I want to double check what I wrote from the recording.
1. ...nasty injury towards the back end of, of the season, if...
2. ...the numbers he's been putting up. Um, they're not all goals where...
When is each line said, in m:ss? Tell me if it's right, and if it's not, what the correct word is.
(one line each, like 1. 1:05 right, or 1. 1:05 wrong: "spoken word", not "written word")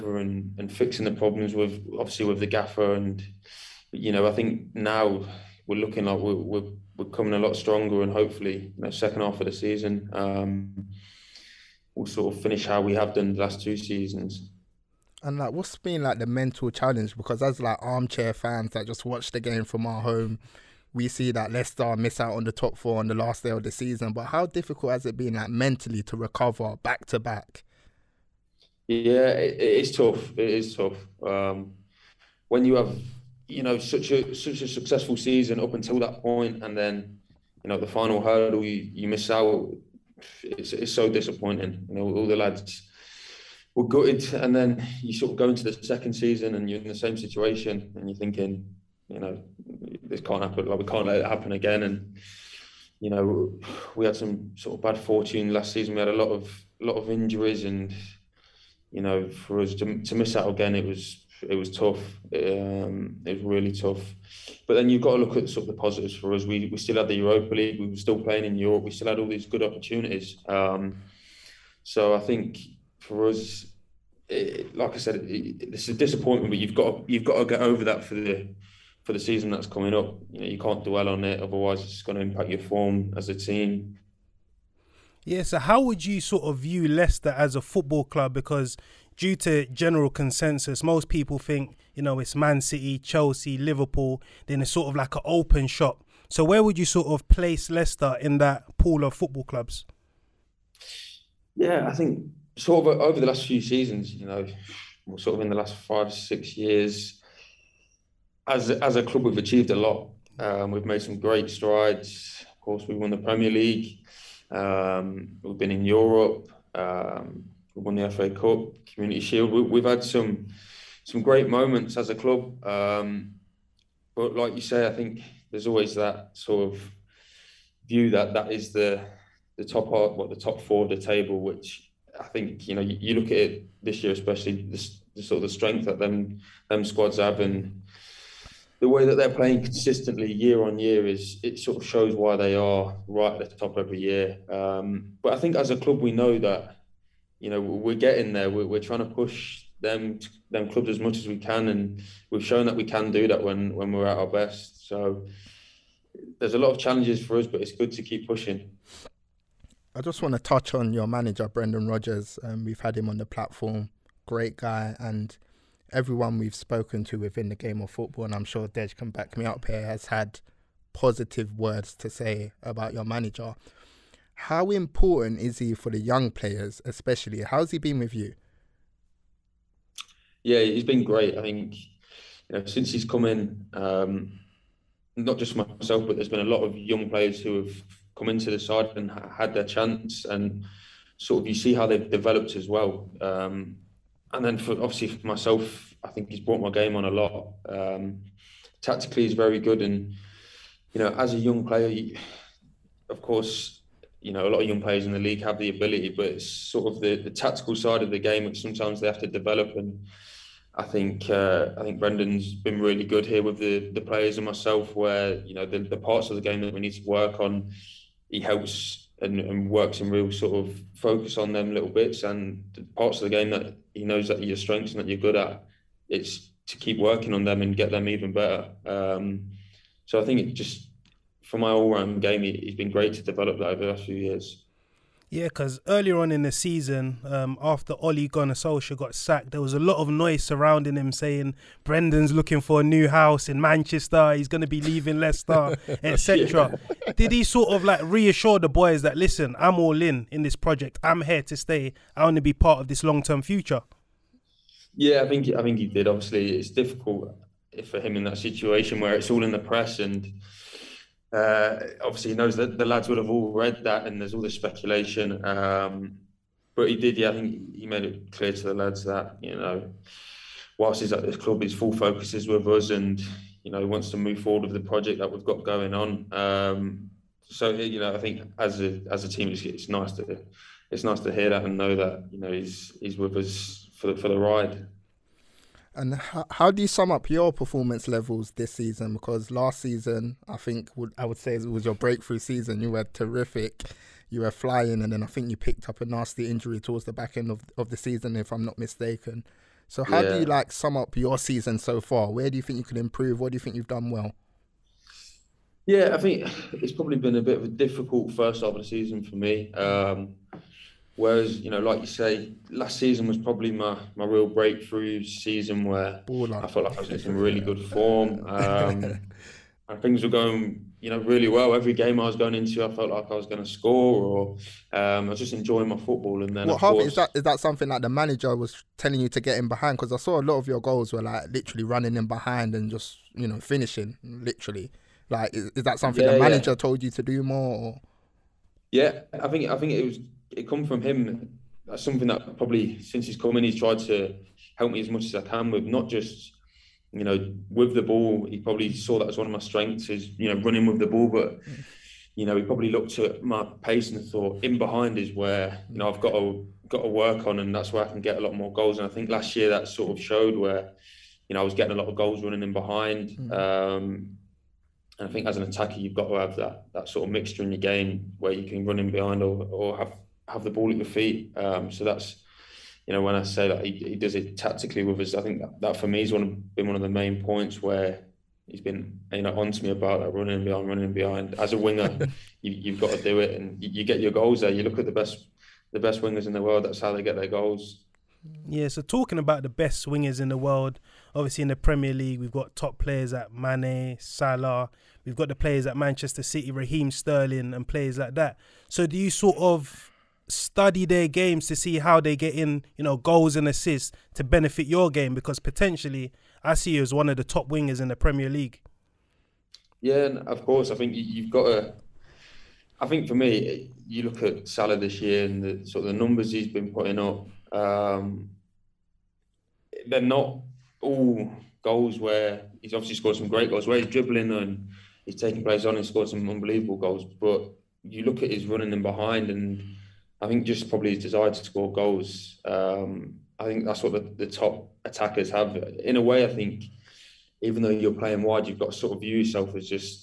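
1. 4:56 right
2. 6:56 right.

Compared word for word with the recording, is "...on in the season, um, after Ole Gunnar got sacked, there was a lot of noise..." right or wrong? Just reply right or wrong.
right.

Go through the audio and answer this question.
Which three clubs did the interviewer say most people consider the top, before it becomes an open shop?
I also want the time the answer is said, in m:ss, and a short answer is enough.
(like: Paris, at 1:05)
Man City, Chelsea, Liverpool, at 1:32.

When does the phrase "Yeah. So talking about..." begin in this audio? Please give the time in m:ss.
6:28.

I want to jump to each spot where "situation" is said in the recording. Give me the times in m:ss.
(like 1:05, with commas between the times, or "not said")
0:47, 4:18.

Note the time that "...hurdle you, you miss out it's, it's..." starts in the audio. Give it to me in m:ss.
0:38.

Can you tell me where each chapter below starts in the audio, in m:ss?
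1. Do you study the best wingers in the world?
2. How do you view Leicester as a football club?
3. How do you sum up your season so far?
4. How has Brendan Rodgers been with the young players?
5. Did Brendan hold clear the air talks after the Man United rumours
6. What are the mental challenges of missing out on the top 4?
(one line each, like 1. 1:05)
1. 6:28
2. 1:24
3. 4:44
4. 2:39
5. 3:55
6. 0:14.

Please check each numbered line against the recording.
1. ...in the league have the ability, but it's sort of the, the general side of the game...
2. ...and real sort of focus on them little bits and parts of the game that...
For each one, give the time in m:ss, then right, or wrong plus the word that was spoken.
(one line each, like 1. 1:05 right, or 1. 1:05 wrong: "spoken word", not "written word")
1. 3:25 wrong: "tactical", not "general"
2. 3:40 right.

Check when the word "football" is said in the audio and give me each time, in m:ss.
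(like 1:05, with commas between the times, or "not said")
1:27, 1:39, 2:47, 5:25.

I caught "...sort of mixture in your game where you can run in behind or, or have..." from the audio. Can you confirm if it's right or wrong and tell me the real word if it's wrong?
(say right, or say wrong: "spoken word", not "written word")
right.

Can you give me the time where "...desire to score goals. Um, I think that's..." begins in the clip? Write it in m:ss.
7:11.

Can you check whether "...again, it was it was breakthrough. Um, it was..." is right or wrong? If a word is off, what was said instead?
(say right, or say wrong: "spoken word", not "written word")
wrong: "tough", not "breakthrough".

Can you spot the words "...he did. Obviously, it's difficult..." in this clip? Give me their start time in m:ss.
4:15.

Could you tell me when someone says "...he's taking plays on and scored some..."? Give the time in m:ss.
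7:05.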